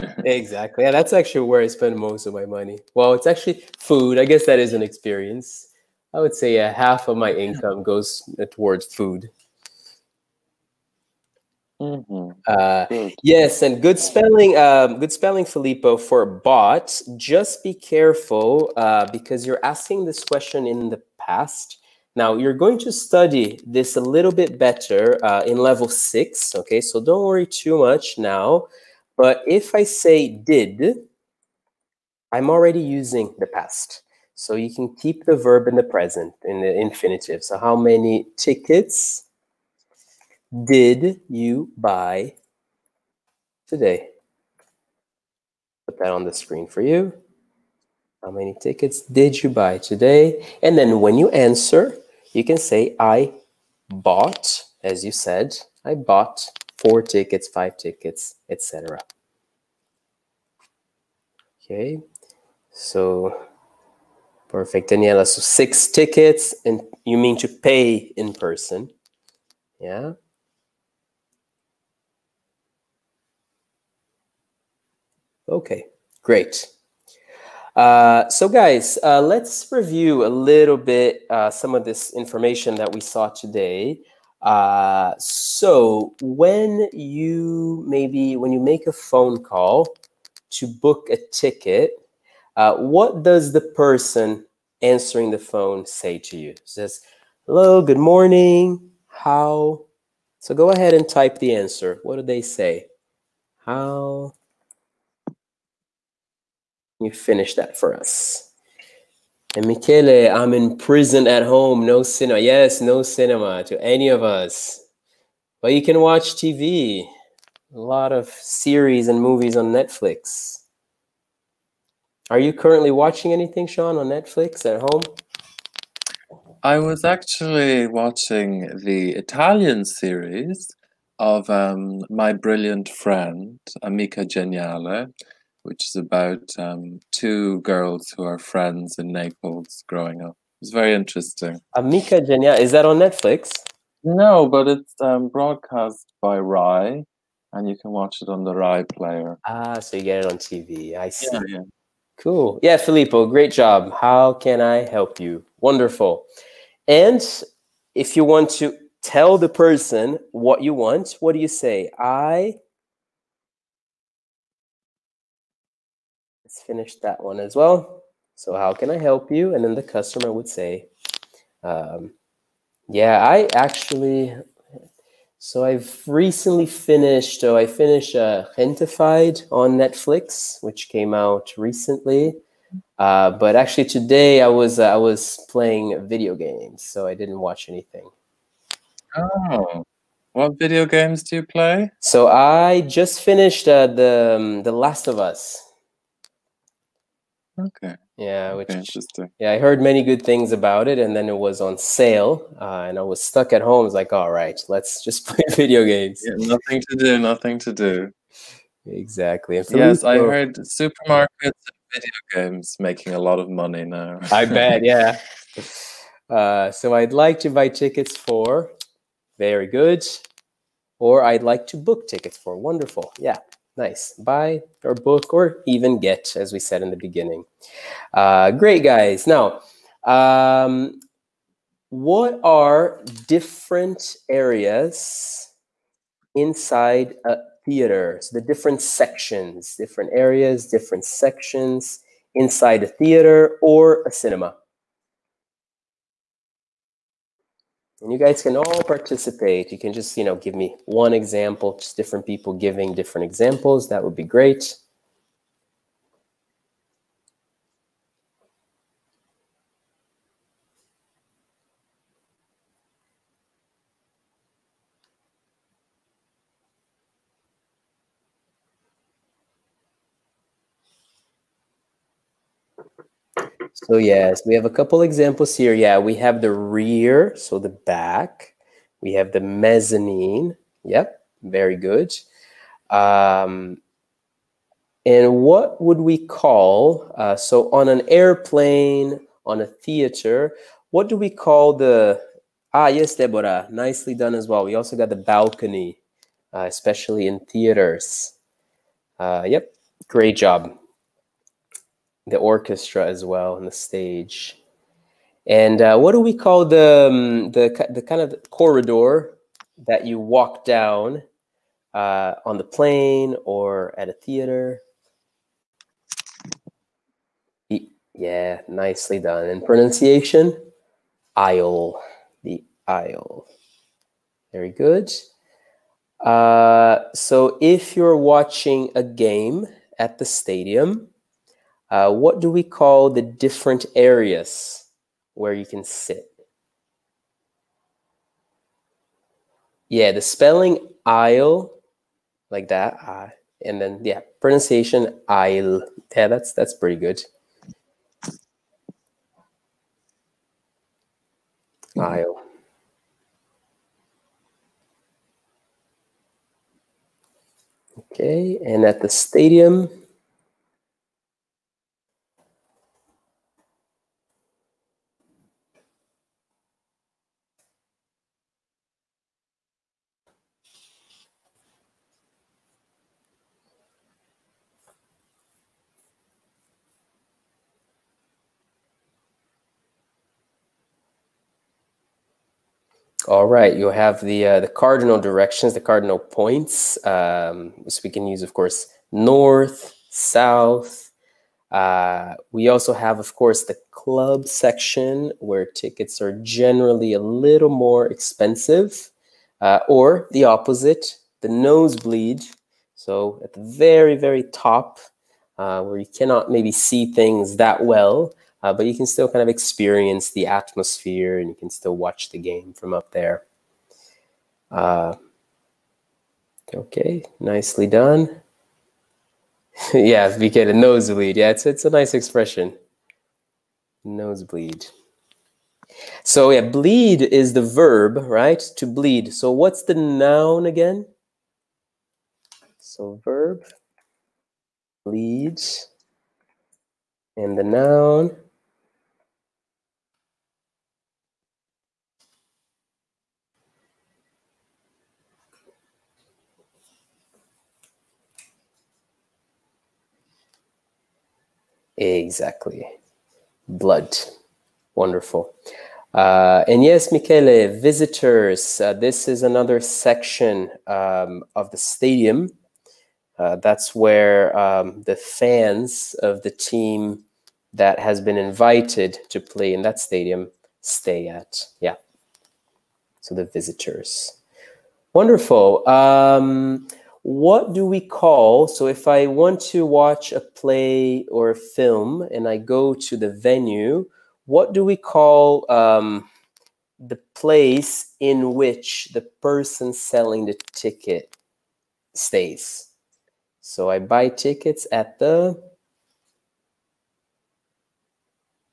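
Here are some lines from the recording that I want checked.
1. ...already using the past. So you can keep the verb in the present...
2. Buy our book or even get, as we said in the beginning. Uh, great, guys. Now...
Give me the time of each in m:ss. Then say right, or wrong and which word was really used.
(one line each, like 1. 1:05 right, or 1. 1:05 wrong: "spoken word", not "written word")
1. 0:32 right
2. 3:44 right.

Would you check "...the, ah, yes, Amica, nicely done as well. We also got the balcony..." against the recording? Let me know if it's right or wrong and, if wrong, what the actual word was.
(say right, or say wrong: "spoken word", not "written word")
wrong: "Deborah", not "Amica".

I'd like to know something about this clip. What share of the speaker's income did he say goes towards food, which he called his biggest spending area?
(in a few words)
half.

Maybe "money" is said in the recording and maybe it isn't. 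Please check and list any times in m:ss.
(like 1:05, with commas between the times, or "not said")
0:02, 3:33.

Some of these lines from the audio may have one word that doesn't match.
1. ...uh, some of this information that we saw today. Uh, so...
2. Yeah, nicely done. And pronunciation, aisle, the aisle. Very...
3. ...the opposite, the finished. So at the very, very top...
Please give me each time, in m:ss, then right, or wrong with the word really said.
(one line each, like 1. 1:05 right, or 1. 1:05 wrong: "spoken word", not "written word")
1. 1:21 right
2. 5:18 right
3. 6:40 wrong: "nosebleed", not "finished".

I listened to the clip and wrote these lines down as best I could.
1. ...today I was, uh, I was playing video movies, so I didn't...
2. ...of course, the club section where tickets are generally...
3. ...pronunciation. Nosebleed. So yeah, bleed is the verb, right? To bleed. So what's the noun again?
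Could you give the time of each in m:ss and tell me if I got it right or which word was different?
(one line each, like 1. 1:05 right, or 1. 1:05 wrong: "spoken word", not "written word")
1. 3:03 wrong: "games", not "movies"
2. 6:33 right
3. 7:02 wrong: "expression", not "pronunciation".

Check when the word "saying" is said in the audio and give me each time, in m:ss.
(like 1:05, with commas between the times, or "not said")
not said.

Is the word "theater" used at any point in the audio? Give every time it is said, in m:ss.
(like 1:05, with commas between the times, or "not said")
3:57, 4:02, 4:49, 4:57, 5:14.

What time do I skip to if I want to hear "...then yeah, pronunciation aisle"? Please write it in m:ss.
5:43.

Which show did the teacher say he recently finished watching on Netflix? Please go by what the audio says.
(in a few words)
Gentefied.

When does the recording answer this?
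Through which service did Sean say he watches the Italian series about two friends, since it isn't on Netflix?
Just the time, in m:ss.
2:28.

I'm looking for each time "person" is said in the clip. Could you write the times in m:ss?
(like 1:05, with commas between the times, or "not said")
1:08, 1:33, 2:39, 8:09.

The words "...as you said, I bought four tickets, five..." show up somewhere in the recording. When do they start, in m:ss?
0:54.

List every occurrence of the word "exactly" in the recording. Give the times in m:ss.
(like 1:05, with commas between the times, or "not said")
0:00, 3:28, 7:32.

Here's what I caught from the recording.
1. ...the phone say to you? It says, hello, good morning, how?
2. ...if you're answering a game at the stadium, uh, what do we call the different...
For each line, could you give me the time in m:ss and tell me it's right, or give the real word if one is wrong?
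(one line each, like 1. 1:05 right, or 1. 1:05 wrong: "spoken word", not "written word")
1. 1:35 right
2. 5:27 wrong: "watching", not "answering".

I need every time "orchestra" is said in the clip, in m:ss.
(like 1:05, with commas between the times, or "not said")
5:02.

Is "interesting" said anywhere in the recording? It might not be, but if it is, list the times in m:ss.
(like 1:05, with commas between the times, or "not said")
2:20, 3:18.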